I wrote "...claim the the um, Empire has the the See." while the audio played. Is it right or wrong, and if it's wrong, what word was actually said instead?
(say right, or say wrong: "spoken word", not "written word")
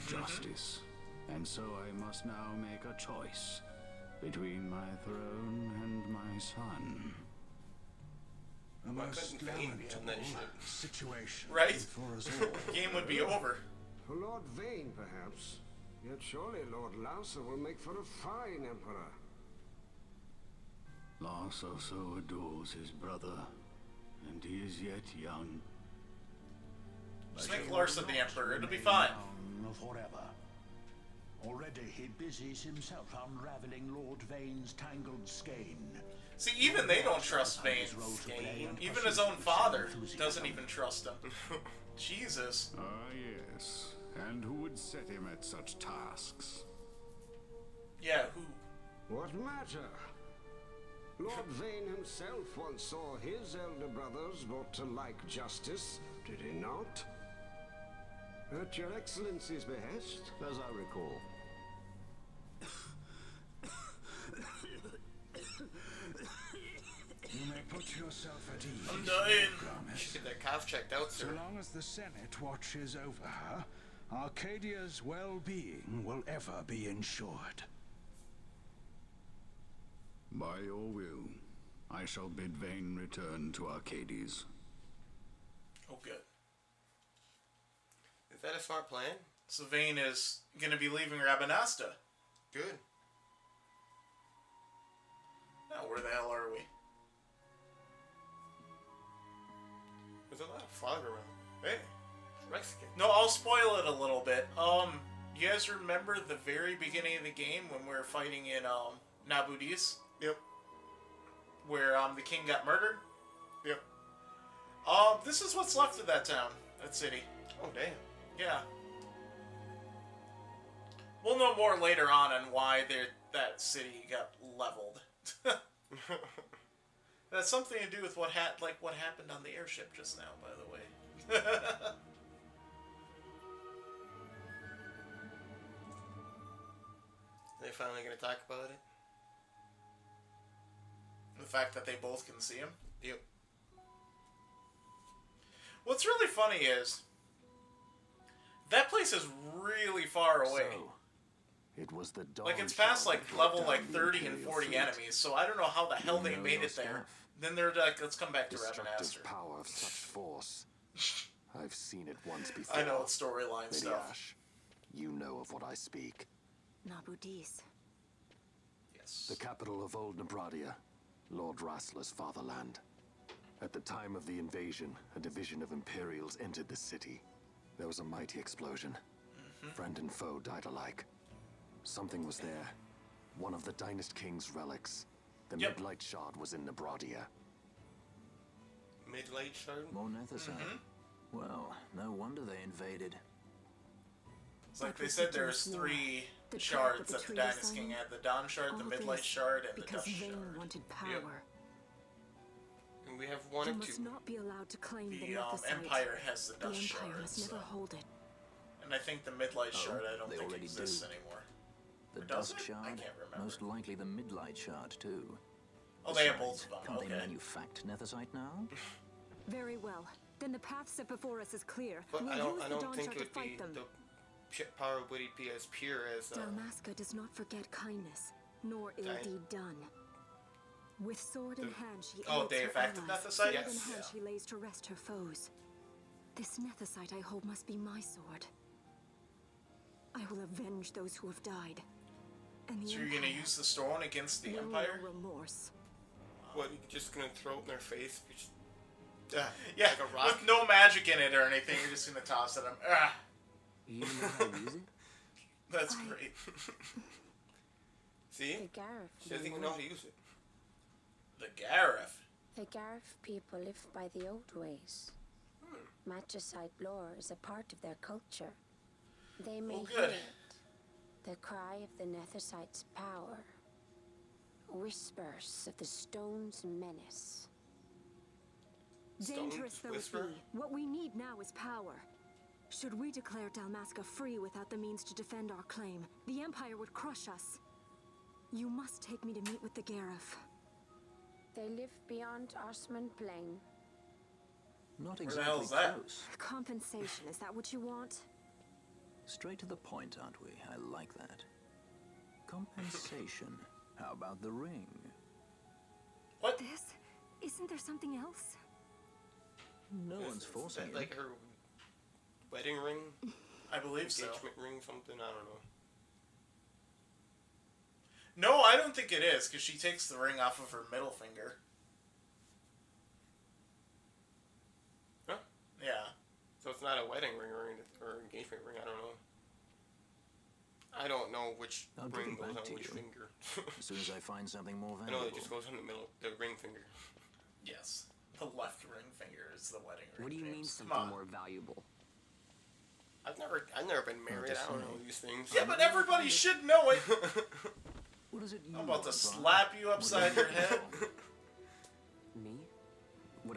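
wrong: "Shard", not "See".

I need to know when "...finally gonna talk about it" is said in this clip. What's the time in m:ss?
2:17.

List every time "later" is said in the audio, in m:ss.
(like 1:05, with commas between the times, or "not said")
2:01.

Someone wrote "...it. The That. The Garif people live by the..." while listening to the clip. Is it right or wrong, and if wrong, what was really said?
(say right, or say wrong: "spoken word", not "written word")
wrong: "Garif", not "That".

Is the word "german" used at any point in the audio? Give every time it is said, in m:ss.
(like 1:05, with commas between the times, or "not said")
not said.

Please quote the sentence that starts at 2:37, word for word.
Then they're like, let's come back to Rabanastre.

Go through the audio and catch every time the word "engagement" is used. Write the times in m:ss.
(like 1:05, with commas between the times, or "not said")
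5:14, 5:28.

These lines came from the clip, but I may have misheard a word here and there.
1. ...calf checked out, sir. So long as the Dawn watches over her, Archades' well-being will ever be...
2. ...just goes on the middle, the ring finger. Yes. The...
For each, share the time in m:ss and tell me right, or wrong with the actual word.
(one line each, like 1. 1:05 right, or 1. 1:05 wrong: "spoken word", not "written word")
1. 1:10 wrong: "Senate", not "Dawn"
2. 5:35 right.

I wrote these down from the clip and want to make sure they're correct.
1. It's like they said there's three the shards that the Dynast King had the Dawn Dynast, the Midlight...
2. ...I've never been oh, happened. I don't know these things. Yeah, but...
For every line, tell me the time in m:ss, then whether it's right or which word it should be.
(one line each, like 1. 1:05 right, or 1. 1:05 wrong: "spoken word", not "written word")
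1. 3:14 wrong: "Shard", not "Dynast"
2. 5:43 wrong: "married", not "happened".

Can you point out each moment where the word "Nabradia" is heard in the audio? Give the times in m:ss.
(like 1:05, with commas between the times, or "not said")
2:50, 3:06.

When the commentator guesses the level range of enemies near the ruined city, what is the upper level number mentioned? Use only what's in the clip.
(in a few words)
40.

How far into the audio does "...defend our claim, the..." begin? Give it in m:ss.
4:45.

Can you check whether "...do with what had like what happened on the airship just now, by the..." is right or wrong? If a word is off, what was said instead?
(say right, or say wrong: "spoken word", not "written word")
right.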